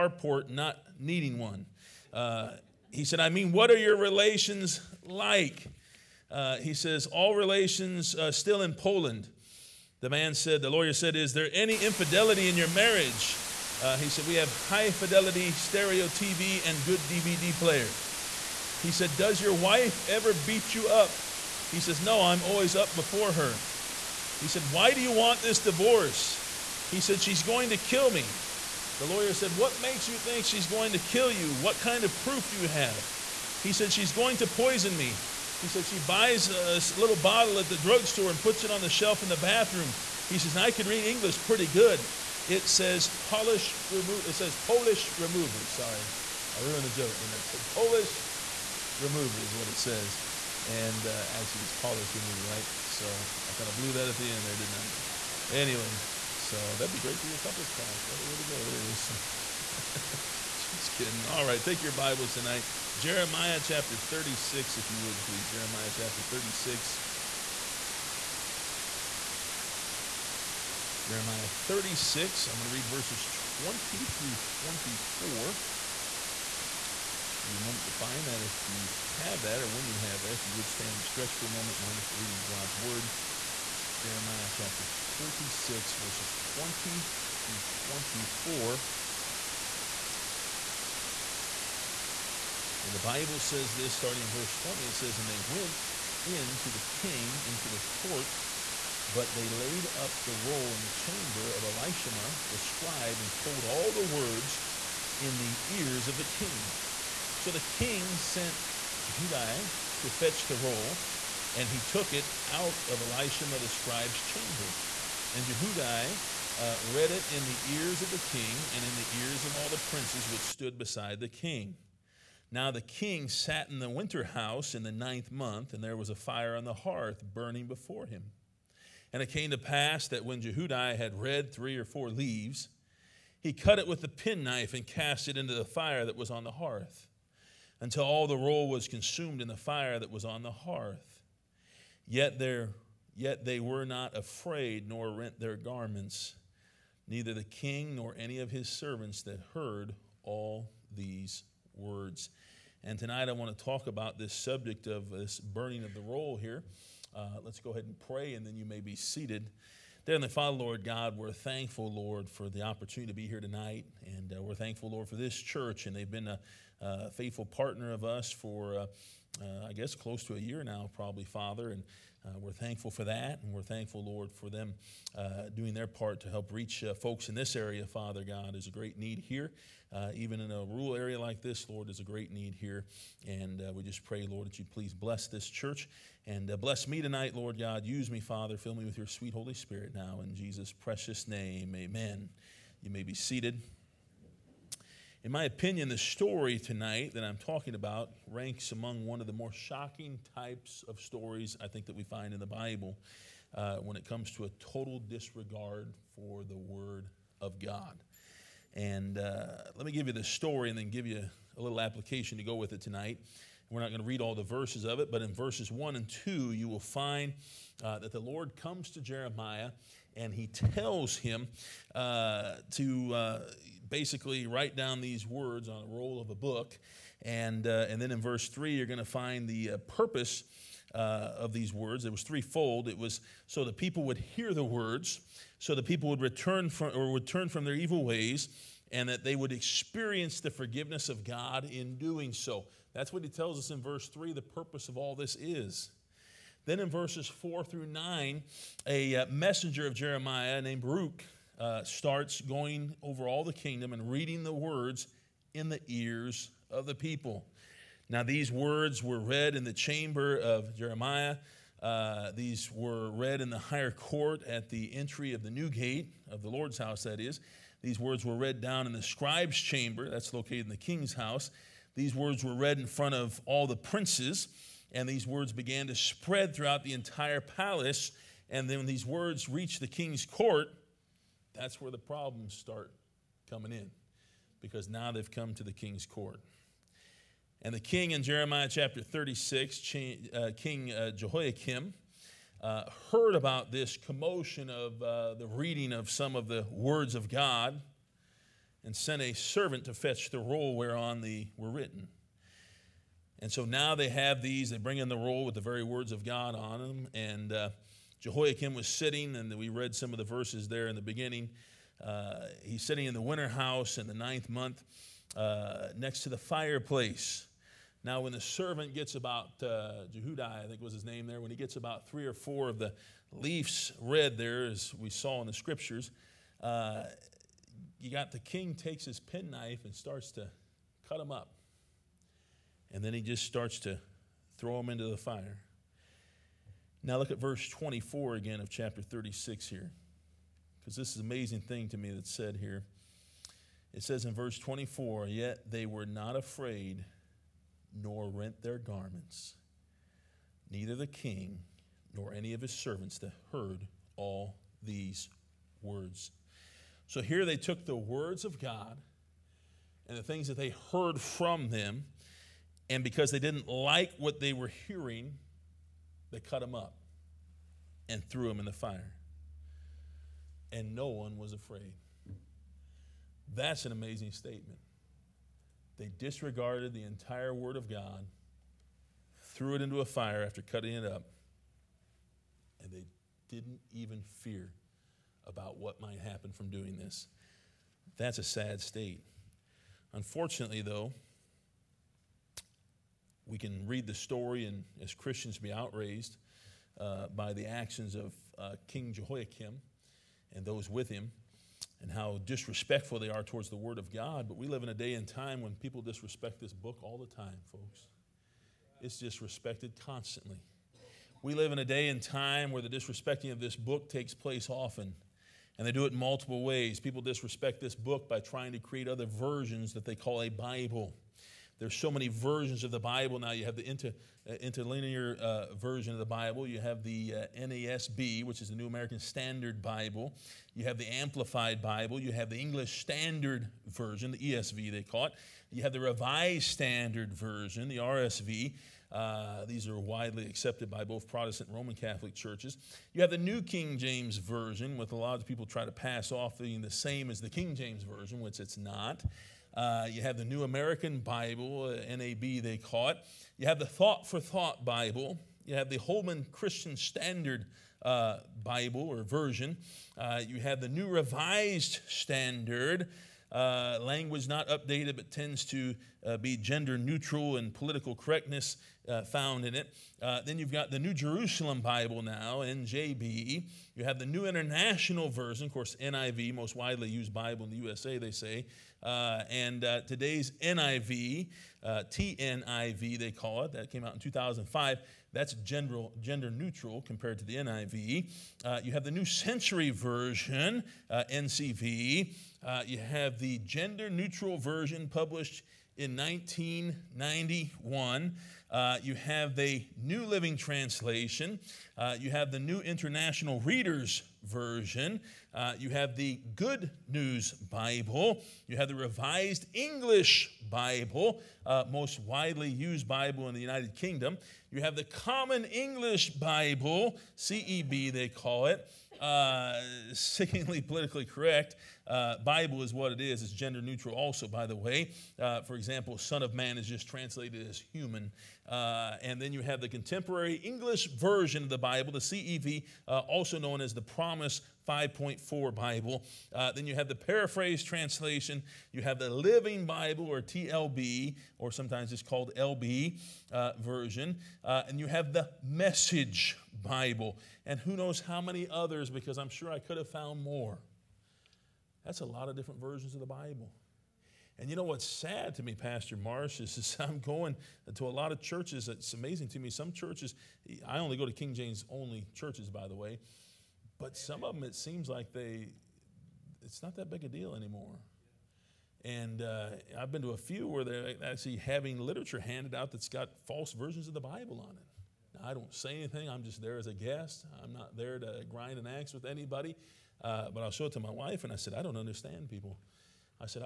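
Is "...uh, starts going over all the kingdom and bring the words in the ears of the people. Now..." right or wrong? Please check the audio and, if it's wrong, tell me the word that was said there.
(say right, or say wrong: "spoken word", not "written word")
wrong: "reading", not "bring".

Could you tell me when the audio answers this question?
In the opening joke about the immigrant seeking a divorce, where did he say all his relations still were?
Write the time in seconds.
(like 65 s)
8 s.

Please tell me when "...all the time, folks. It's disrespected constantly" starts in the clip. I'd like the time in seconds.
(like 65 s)
407 s.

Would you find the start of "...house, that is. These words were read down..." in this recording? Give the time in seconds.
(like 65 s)
266 s.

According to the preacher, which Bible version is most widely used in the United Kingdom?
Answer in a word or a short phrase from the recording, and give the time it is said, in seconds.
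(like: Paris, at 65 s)
Revised English Bible, at 508 s.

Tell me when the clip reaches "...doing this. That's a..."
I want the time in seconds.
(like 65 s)
386 s.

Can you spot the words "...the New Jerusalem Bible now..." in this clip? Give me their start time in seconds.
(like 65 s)
470 s.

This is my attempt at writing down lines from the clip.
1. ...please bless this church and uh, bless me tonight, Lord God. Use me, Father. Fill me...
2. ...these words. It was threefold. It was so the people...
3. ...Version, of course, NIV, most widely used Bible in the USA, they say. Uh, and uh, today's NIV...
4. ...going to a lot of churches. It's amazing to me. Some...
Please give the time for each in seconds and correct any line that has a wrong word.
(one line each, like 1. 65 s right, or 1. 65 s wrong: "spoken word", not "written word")
1. 184 s right
2. 231 s right
3. 475 s right
4. 557 s right.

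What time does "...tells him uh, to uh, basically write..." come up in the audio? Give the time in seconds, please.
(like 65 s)
220 s.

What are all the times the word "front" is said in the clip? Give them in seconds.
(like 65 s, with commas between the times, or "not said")
272 s.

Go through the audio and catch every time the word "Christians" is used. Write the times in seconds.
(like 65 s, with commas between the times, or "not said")
395 s, 456 s.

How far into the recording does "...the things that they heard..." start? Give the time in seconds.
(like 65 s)
360 s.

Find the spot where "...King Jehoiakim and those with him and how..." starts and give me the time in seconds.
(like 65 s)
398 s.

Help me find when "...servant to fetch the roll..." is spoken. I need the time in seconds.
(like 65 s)
299 s.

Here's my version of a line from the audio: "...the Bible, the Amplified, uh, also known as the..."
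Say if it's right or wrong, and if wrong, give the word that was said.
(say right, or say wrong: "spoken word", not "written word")
wrong: "CEV", not "Amplified".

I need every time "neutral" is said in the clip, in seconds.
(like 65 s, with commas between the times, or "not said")
466 s, 486 s, 494 s, 523 s.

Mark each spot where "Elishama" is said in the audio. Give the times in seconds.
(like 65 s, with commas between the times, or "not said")
101 s, 112 s.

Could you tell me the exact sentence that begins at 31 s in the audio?
What kind of proof do you have?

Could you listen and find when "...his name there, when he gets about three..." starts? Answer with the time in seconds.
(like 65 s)
320 s.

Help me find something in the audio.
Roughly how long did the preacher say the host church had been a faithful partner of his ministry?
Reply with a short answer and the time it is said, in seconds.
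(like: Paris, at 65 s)
Close to a year, at 169 s.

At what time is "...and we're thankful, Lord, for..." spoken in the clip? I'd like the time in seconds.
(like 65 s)
173 s.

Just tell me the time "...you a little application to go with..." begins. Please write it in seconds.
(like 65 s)
211 s.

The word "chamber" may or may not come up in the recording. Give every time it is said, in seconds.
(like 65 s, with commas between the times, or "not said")
100 s, 114 s, 259 s, 269 s.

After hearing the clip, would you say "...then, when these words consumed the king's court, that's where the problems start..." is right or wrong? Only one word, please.
wrong.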